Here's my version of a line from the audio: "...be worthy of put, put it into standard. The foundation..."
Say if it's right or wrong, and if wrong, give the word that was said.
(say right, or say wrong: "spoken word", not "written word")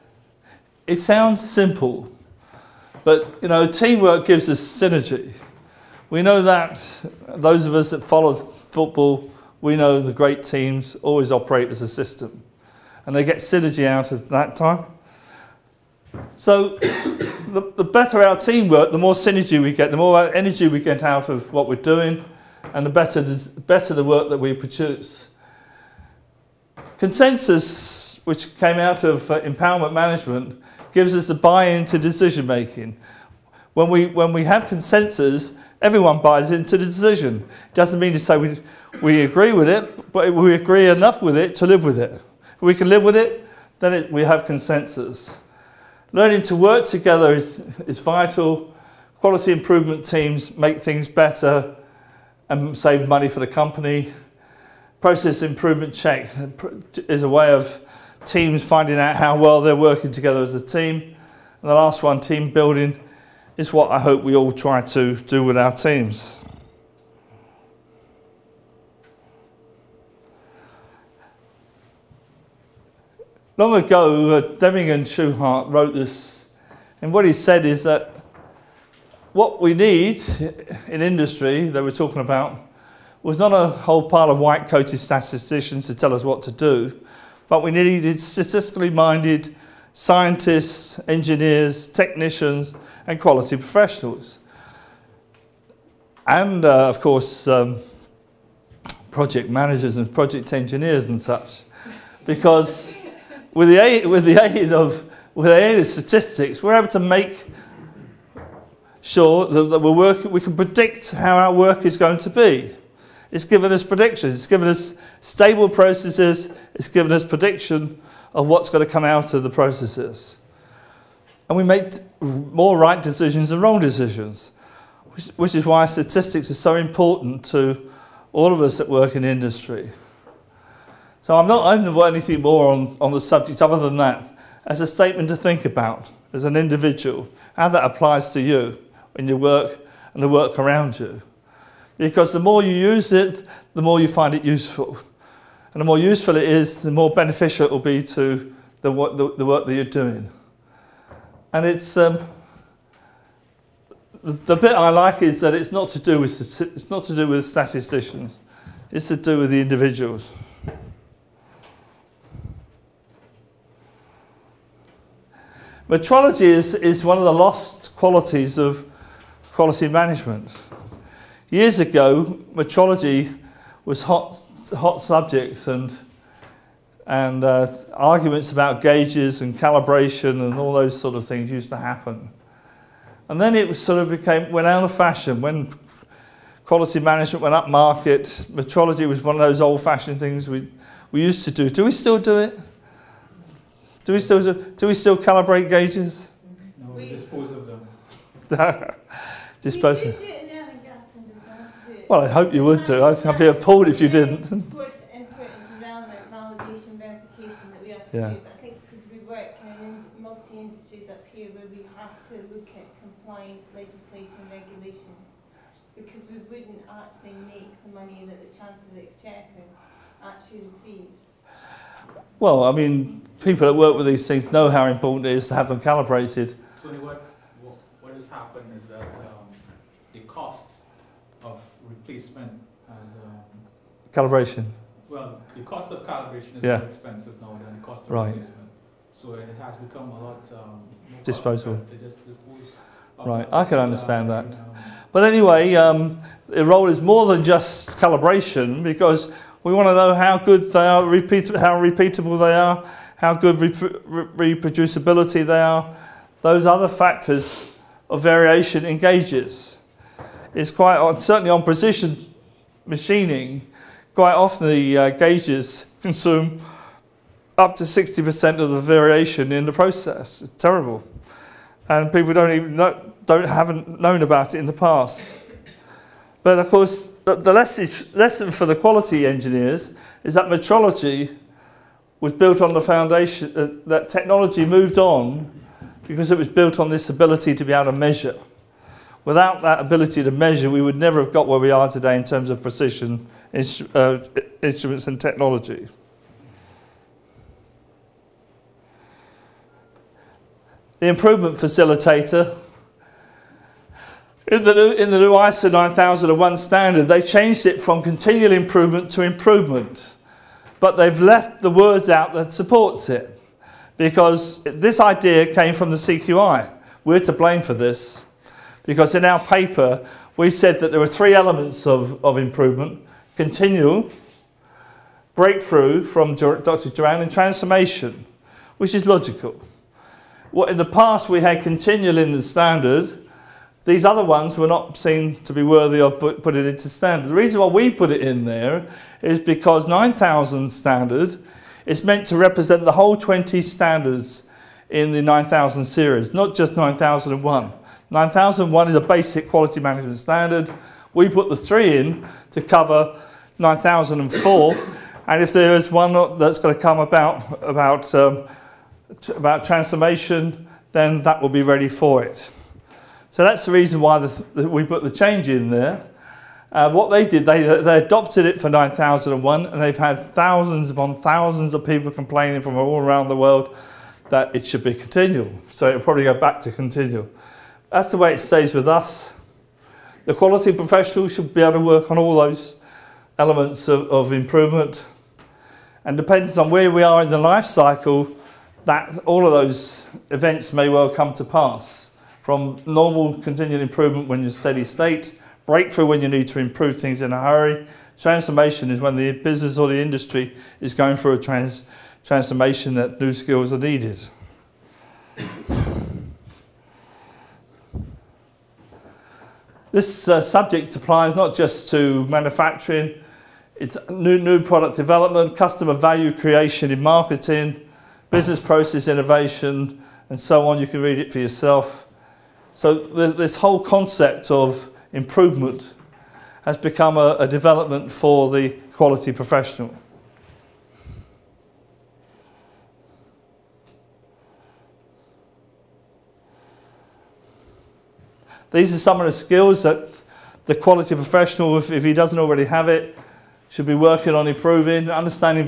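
wrong: "reason", not "foundation".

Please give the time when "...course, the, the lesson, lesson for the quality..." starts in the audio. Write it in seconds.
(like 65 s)
276 s.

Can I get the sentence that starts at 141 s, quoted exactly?
Because the more you use it, the more you find it useful.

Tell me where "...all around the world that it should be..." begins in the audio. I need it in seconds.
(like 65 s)
372 s.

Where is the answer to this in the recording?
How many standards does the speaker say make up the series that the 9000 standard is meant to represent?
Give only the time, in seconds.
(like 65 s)
343 s.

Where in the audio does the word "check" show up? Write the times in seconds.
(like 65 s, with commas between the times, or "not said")
55 s.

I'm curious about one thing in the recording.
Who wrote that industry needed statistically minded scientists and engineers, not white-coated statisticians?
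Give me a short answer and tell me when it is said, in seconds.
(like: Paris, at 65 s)
Shewhart, at 75 s.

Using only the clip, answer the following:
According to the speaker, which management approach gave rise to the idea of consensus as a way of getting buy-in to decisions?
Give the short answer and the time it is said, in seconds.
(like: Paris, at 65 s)
empowerment management, at 29 s.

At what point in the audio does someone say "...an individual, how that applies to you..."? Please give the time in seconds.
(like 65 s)
136 s.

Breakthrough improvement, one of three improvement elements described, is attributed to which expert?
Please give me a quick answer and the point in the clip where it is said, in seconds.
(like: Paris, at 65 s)
Dr. Juran, at 326 s.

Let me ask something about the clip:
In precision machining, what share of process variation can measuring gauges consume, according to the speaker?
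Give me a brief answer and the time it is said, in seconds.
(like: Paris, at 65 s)
60%, at 267 s.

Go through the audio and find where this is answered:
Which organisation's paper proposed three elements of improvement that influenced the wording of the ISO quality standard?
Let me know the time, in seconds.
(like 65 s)
315 s.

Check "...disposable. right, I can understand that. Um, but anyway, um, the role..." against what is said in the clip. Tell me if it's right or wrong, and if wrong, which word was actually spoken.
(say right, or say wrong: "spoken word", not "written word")
right.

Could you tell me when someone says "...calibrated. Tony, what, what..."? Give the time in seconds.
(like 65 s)
225 s.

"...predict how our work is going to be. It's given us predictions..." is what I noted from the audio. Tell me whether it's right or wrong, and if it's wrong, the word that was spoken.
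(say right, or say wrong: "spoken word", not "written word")
right.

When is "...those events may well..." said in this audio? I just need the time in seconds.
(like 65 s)
389 s.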